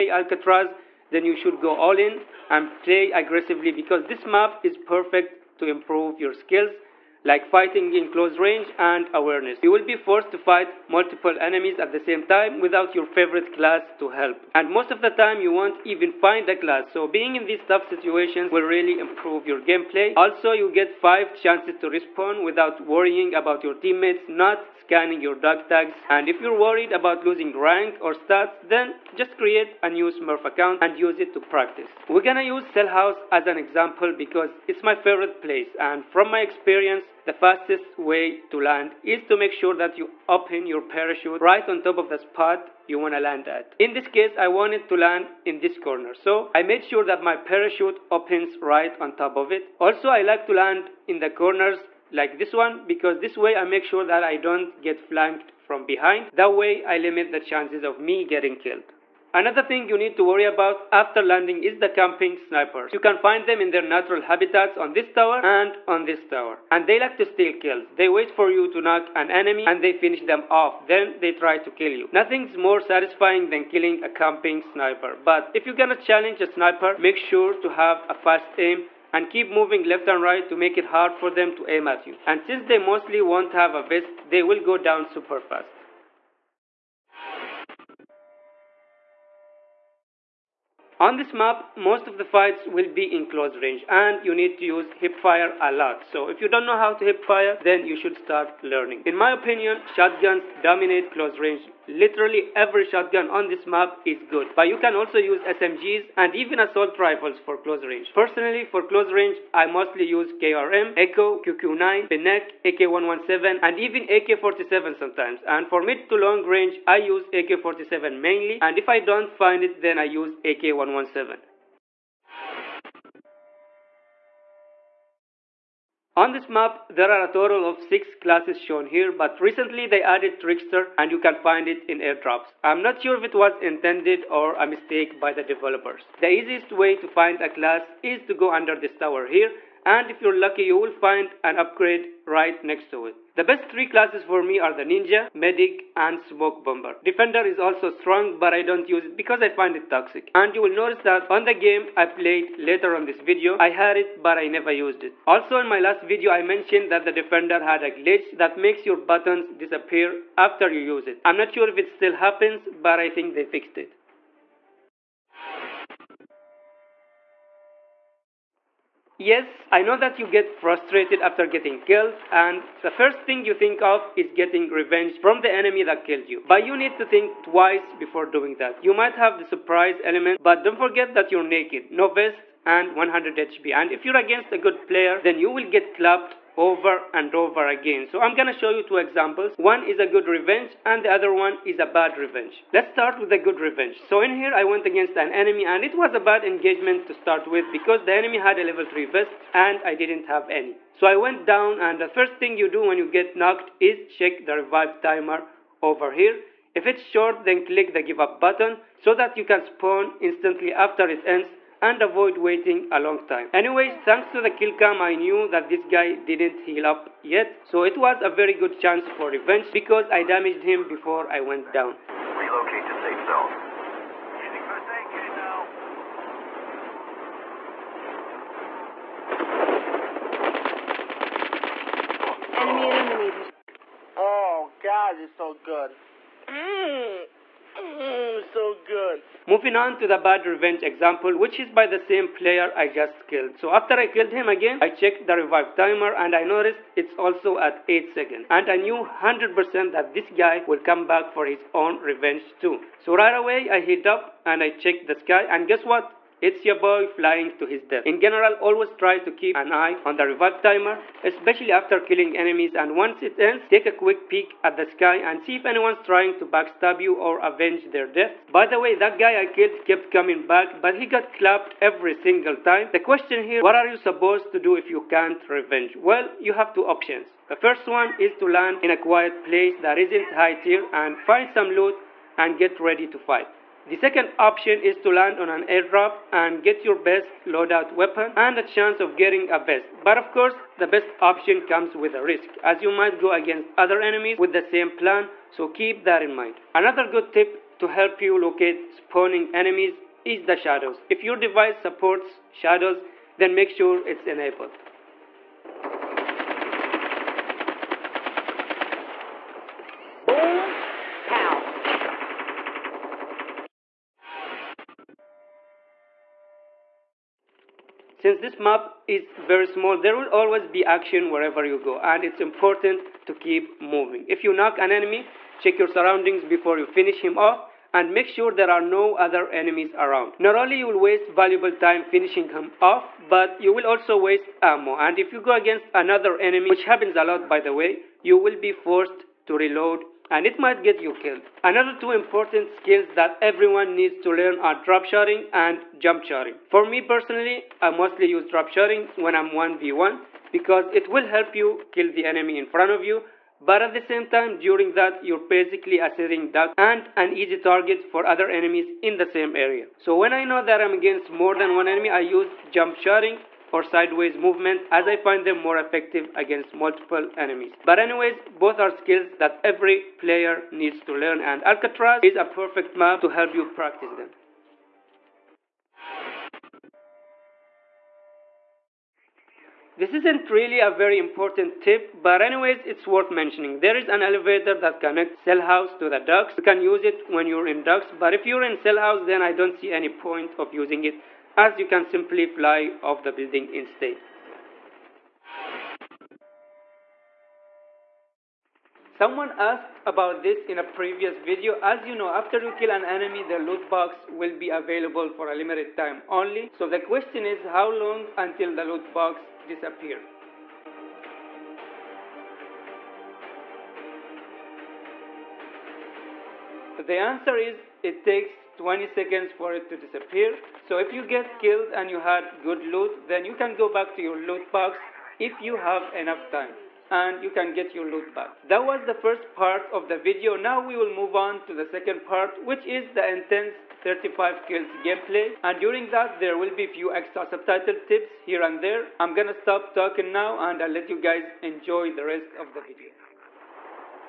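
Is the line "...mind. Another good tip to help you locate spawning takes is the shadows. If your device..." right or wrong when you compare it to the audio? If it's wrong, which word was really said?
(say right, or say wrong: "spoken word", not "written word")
wrong: "enemies", not "takes".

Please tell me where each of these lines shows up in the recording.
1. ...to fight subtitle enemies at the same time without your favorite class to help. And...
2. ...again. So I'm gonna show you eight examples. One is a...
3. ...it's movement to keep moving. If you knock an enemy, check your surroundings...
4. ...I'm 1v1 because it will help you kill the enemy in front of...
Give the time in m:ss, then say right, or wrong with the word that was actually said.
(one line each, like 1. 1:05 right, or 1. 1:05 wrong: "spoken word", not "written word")
1. 0:10 wrong: "multiple", not "subtitle"
2. 3:07 wrong: "two", not "eight"
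3. 5:22 wrong: "important", not "movement"
4. 5:49 right.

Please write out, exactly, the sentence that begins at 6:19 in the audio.
This isn't really a very important tip, but anyways, it's worth mentioning.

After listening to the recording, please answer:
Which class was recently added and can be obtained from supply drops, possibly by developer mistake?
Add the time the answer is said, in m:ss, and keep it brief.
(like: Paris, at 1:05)
Trickster, at 2:10.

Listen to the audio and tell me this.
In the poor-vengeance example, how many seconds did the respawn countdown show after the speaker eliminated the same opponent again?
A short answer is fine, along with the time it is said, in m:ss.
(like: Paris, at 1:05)
8 seconds, at 4:07.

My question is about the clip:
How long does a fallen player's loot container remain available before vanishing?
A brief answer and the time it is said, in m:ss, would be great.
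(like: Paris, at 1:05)
20 seconds, at 6:58.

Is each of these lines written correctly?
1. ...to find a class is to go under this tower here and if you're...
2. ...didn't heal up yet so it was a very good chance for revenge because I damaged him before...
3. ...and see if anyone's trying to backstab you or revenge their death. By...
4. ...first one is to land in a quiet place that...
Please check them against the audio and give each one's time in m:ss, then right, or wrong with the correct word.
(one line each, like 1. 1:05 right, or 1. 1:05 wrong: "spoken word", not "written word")
1. 2:16 right
2. 3:36 right
3. 4:25 wrong: "avenge", not "revenge"
4. 4:37 right.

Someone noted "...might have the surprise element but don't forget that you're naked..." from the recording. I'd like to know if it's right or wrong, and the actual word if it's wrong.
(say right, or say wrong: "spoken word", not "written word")
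right.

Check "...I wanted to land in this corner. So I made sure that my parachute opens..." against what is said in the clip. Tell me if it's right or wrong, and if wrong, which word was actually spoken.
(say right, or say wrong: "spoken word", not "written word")
right.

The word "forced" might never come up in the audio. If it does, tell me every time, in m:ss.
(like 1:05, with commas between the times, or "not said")
0:09, 5:38.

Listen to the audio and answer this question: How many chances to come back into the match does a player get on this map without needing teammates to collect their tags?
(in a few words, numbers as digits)
5.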